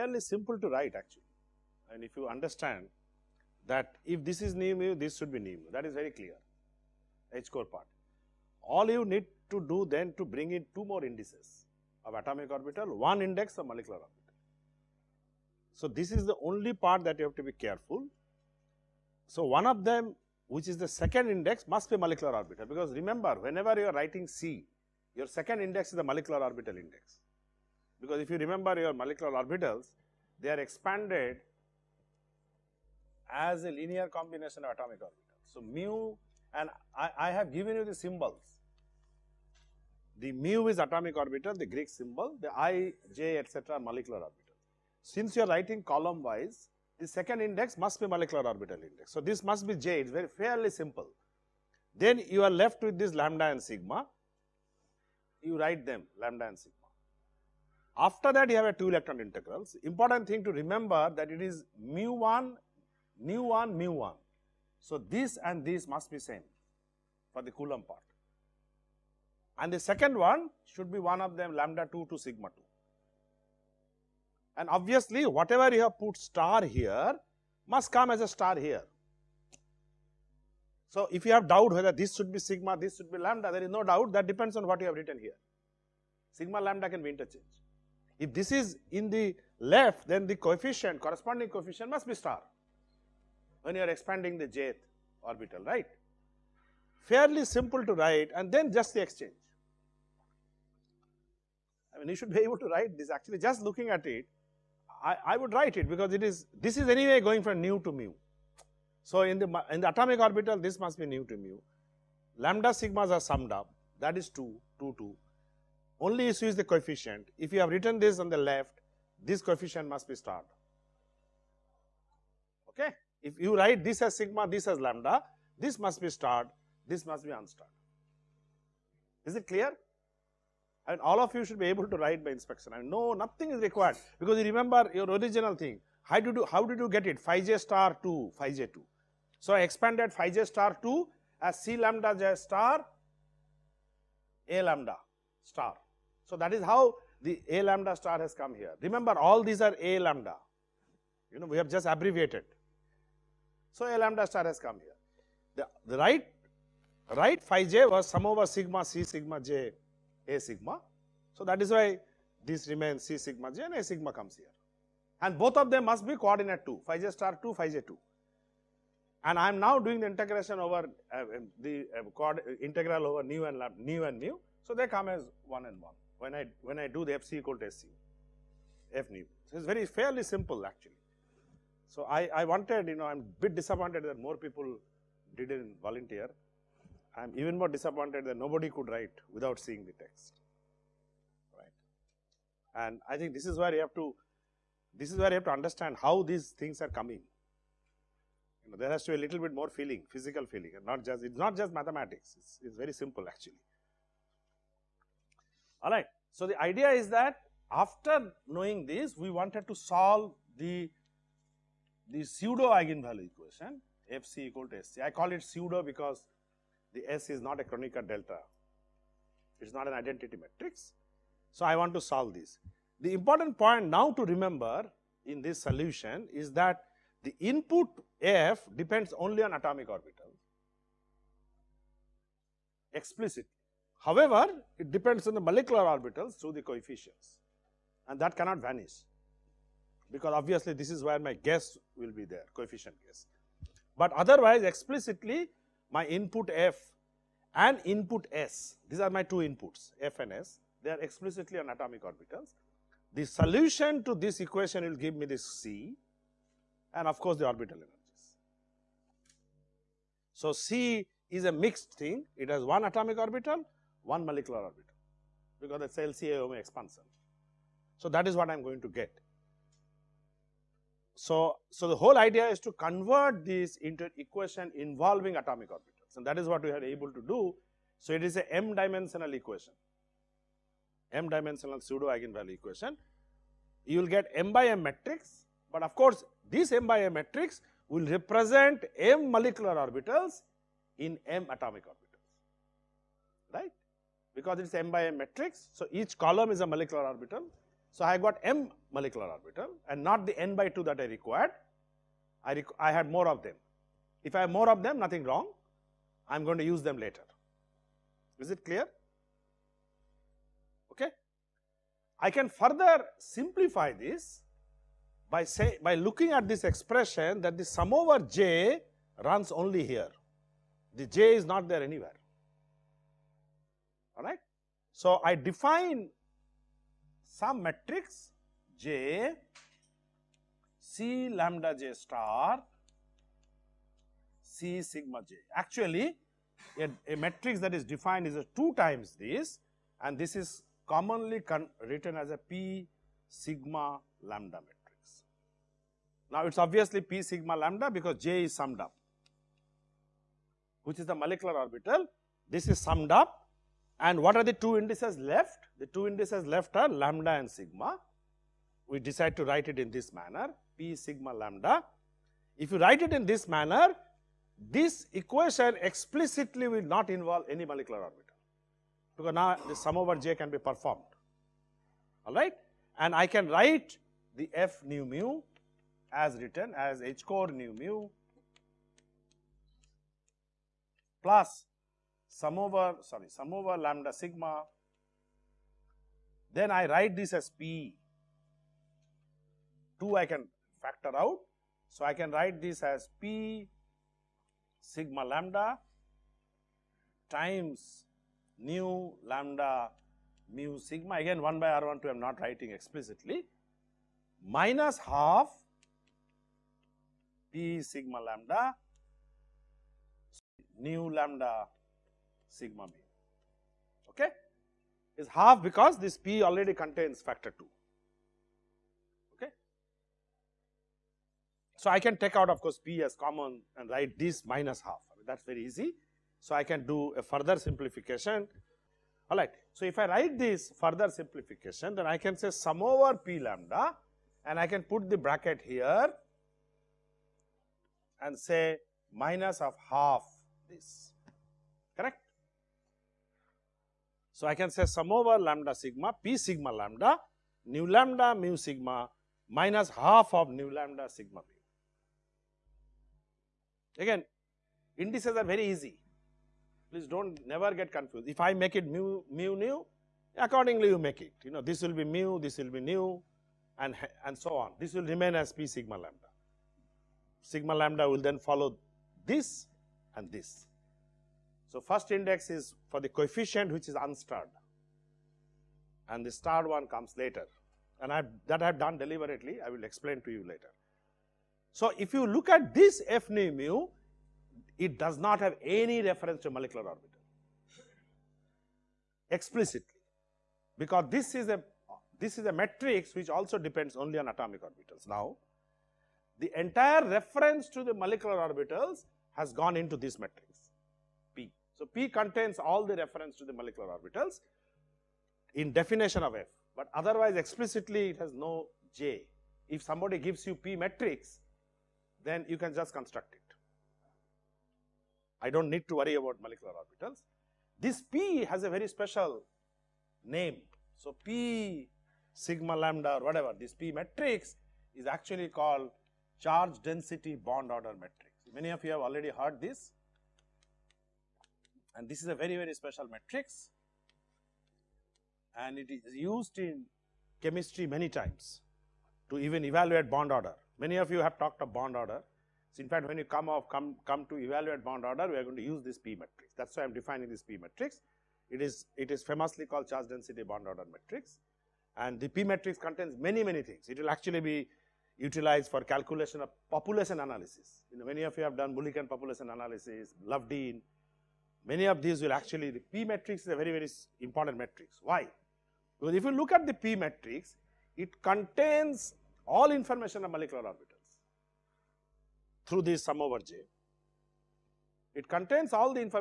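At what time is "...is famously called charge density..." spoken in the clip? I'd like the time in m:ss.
9:09.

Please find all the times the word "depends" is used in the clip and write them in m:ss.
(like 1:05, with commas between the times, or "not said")
1:24, 3:48, 3:54, 8:13.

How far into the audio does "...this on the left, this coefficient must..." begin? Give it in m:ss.
1:57.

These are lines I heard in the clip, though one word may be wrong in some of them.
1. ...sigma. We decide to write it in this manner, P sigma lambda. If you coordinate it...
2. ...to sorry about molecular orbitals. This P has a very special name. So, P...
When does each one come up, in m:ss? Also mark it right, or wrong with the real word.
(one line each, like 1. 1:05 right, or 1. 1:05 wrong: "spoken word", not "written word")
1. 5:57 wrong: "write", not "coordinate"
2. 8:35 wrong: "worry", not "sorry".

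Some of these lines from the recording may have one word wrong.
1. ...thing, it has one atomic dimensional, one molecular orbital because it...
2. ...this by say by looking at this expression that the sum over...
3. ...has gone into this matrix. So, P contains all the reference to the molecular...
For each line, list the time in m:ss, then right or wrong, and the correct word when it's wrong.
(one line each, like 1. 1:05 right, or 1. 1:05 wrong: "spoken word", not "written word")
1. 4:21 wrong: "orbital", not "dimensional"
2. 5:13 right
3. 8:19 right.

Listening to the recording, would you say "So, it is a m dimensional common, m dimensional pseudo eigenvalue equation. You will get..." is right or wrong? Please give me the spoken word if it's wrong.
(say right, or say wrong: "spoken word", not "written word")
wrong: "equation", not "common".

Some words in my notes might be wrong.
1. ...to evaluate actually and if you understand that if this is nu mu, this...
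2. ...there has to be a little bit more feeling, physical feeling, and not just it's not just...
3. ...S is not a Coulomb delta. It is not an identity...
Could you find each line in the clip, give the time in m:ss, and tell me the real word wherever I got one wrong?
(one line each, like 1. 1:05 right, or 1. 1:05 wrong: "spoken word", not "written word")
1. 0:00 wrong: "write", not "evaluate"
2. 3:18 right
3. 3:37 wrong: "Kronecker", not "Coulomb".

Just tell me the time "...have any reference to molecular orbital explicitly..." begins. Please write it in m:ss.
8:05.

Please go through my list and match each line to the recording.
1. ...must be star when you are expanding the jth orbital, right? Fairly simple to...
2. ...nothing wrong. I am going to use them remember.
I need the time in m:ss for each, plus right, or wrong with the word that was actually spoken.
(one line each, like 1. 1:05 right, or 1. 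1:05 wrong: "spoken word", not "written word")
1. 1:31 right
2. 5:04 wrong: "later", not "remember".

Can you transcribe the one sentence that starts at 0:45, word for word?
Since you are writing column wise, the second index must be molecular orbital index.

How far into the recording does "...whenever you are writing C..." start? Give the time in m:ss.
0:23.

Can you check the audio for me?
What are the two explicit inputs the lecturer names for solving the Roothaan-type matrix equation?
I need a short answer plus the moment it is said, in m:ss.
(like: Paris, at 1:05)
F and S, at 4:10.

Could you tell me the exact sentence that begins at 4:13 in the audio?
The solution to this equation will give me this C and of course, the orbital energies.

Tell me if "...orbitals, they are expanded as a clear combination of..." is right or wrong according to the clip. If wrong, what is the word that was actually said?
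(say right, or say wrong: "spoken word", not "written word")
wrong: "linear", not "clear".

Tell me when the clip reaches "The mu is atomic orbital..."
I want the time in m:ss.
0:40.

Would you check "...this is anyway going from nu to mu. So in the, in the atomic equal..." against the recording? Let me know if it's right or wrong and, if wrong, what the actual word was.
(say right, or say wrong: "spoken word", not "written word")
wrong: "orbital", not "equal".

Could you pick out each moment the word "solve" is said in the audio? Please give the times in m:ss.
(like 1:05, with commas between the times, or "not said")
3:29, 3:42.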